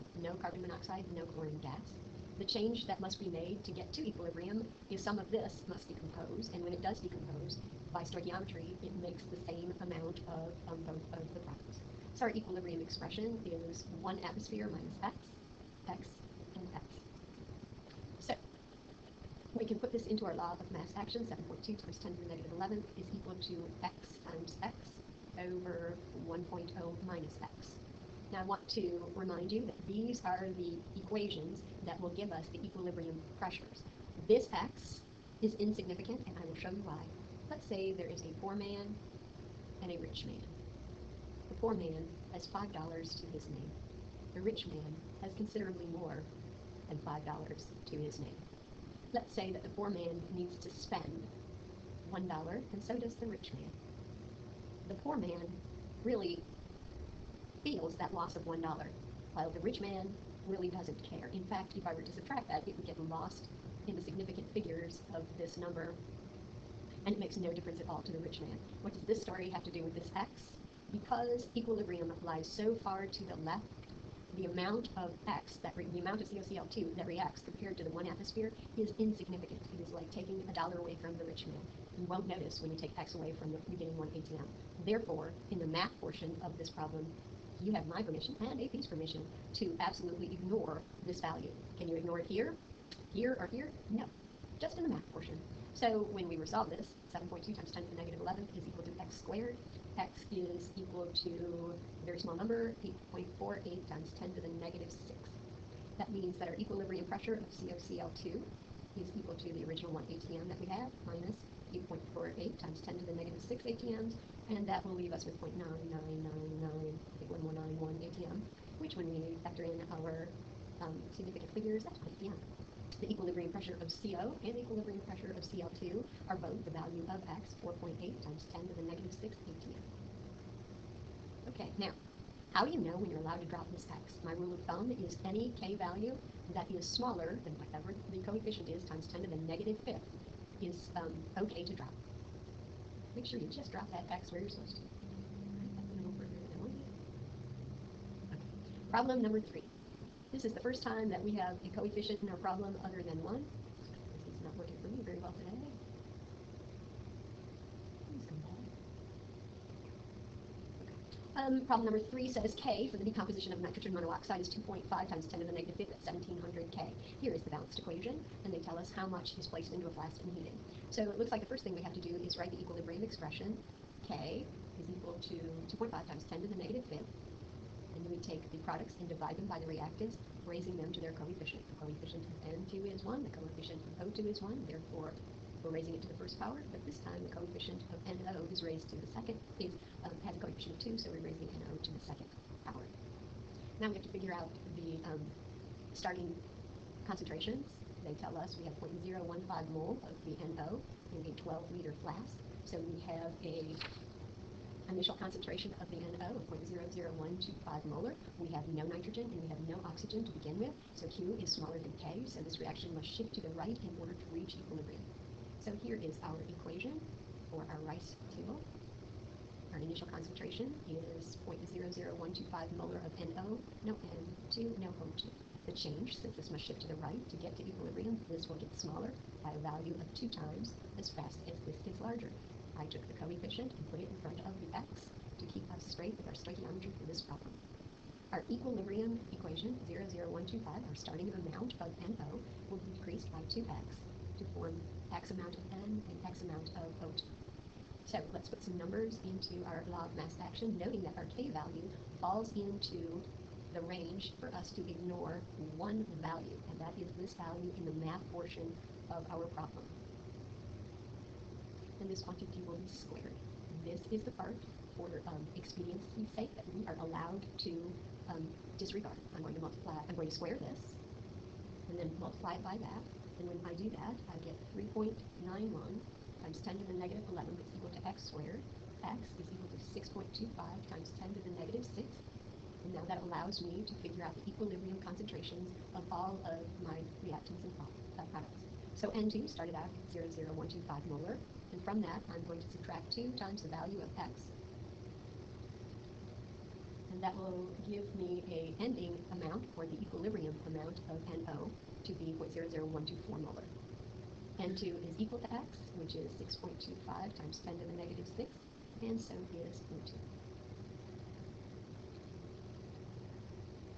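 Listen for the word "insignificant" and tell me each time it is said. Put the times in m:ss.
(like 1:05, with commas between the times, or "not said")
0:35, 1:18.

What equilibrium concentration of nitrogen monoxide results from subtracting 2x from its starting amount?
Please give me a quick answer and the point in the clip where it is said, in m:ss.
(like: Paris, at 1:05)
0.00124 molar, at 5:02.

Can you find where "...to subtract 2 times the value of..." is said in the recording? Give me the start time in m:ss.
4:52.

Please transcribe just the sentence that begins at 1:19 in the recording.
It is like taking a dollar away from the rich man.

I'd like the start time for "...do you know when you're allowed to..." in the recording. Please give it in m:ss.
2:12.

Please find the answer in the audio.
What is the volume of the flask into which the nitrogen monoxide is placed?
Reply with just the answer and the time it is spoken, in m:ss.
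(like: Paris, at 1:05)
12 liters, at 3:21.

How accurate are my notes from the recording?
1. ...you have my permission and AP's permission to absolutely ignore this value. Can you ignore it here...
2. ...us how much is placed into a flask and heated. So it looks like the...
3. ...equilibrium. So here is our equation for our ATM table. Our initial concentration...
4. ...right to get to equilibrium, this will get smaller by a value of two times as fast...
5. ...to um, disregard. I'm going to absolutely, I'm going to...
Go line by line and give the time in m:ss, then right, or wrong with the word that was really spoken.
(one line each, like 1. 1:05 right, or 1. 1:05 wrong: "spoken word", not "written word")
1. 1:27 right
2. 2:48 right
3. 3:34 wrong: "RICE", not "ATM"
4. 3:47 right
5. 4:27 wrong: "multiply", not "absolutely".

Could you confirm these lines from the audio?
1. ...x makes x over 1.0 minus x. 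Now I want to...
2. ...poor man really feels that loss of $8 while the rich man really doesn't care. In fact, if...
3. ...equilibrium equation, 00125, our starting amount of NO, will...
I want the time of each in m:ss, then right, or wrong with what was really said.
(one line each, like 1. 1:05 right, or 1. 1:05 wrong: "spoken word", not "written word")
1. 0:23 wrong: "times", not "makes"
2. 0:55 wrong: "1", not "8"
3. 3:58 right.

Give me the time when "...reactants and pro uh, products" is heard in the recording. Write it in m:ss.
4:47.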